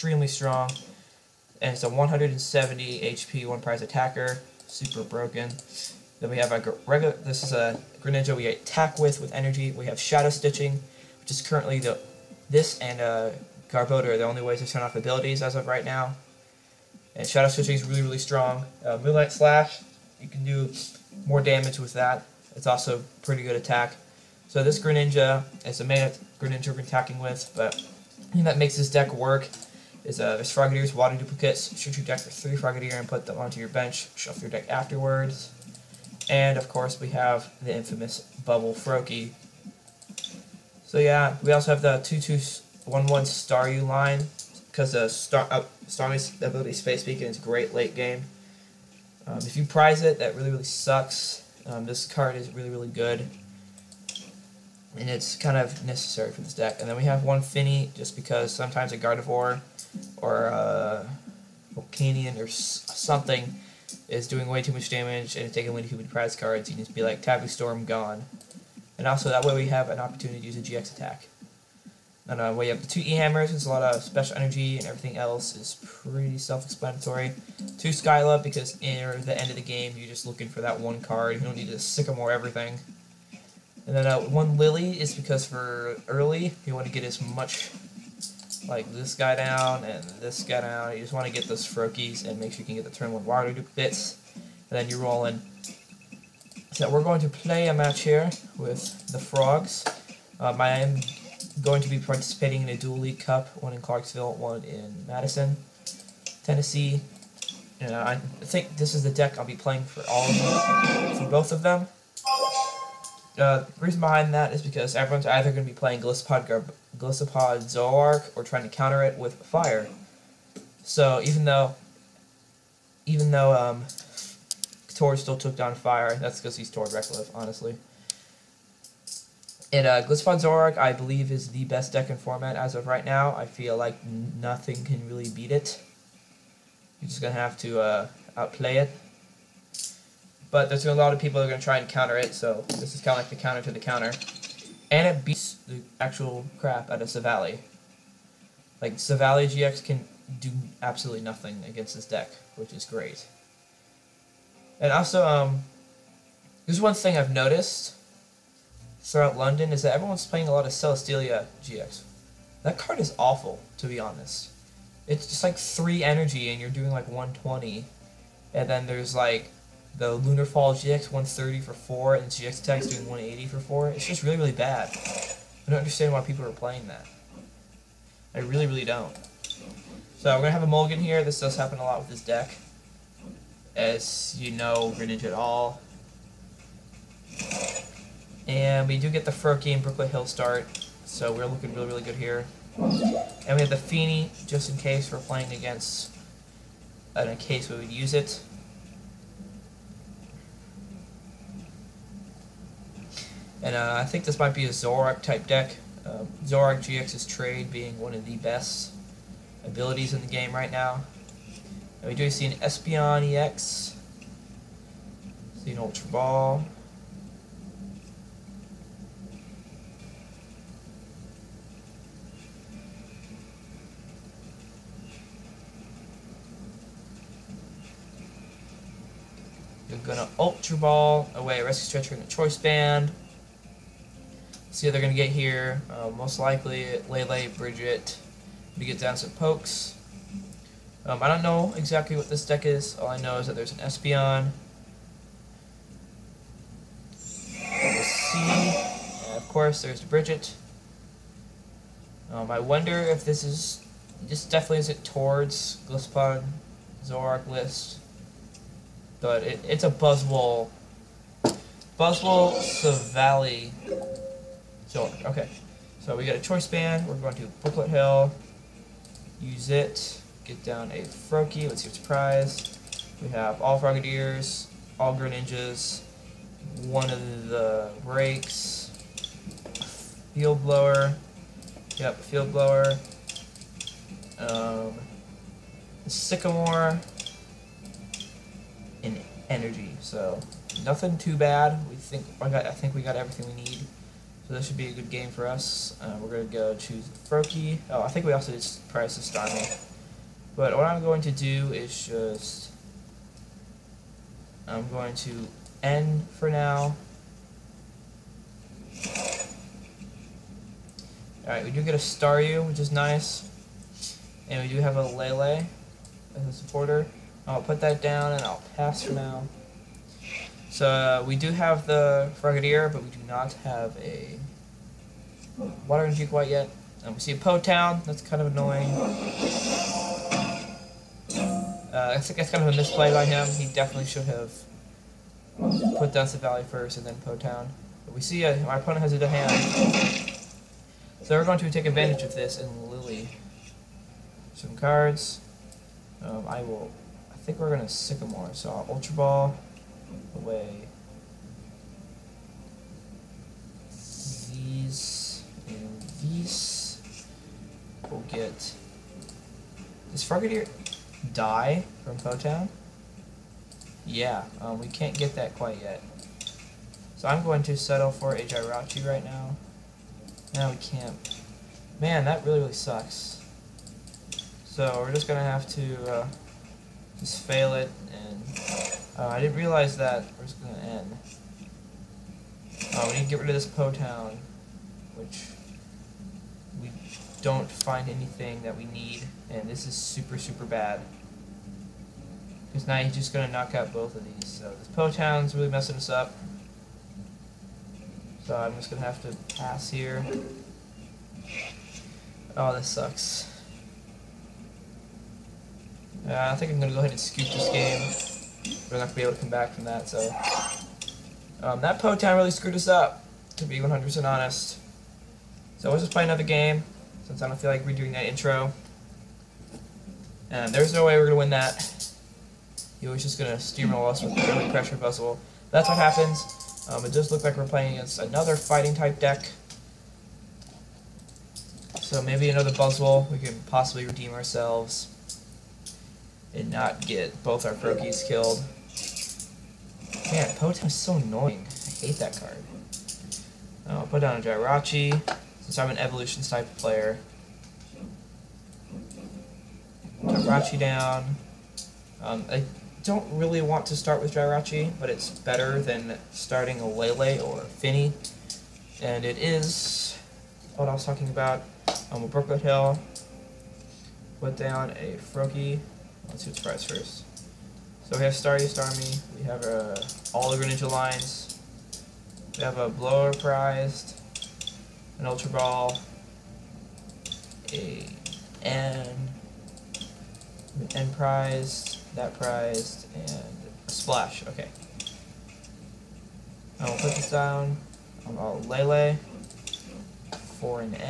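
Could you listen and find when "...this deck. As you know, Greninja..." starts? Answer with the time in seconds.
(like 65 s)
182 s.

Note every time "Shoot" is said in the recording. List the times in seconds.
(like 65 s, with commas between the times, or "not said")
31 s.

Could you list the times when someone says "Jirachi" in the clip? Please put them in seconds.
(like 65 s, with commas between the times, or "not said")
368 s, 444 s, 450 s, 454 s.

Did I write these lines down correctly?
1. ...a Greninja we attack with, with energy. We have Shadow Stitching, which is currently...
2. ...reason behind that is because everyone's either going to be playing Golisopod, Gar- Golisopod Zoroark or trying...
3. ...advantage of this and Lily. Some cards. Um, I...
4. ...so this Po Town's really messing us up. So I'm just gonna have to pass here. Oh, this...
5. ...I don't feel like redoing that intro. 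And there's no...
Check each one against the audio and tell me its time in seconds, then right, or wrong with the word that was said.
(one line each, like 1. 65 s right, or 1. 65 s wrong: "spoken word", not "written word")
1. 7 s right
2. 113 s right
3. 341 s right
4. 394 s right
5. 417 s right.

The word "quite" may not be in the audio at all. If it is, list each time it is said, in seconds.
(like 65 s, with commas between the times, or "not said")
326 s, 365 s.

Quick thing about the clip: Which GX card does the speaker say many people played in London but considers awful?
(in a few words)
Celesteela GX.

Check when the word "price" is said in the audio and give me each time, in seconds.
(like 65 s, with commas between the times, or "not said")
298 s, 466 s.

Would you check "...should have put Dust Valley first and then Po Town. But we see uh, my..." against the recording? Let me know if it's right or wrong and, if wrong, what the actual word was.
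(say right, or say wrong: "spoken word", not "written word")
right.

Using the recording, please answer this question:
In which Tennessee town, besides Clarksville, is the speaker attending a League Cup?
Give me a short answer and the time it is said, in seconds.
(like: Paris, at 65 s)
Madison, at 105 s.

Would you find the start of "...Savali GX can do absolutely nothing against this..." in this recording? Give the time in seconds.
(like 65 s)
148 s.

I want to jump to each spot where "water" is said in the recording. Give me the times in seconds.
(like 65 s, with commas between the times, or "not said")
30 s, 93 s, 325 s.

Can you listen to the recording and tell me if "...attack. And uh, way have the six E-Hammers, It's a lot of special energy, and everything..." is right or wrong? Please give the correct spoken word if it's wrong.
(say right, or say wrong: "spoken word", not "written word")
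wrong: "two", not "six".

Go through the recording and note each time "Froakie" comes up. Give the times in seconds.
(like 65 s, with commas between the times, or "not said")
38 s, 91 s, 189 s, 271 s, 297 s, 437 s, 465 s.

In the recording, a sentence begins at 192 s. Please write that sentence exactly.
And we have the Fini, just in case we're playing against, in a case we would use it.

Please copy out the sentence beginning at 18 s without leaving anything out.
Uh, Moonlight Slash, you can do more damage with that.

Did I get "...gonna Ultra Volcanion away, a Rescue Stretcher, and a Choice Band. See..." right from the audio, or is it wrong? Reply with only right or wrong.
wrong.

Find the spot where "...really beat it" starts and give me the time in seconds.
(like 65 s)
135 s.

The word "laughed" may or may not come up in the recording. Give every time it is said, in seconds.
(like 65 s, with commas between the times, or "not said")
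not said.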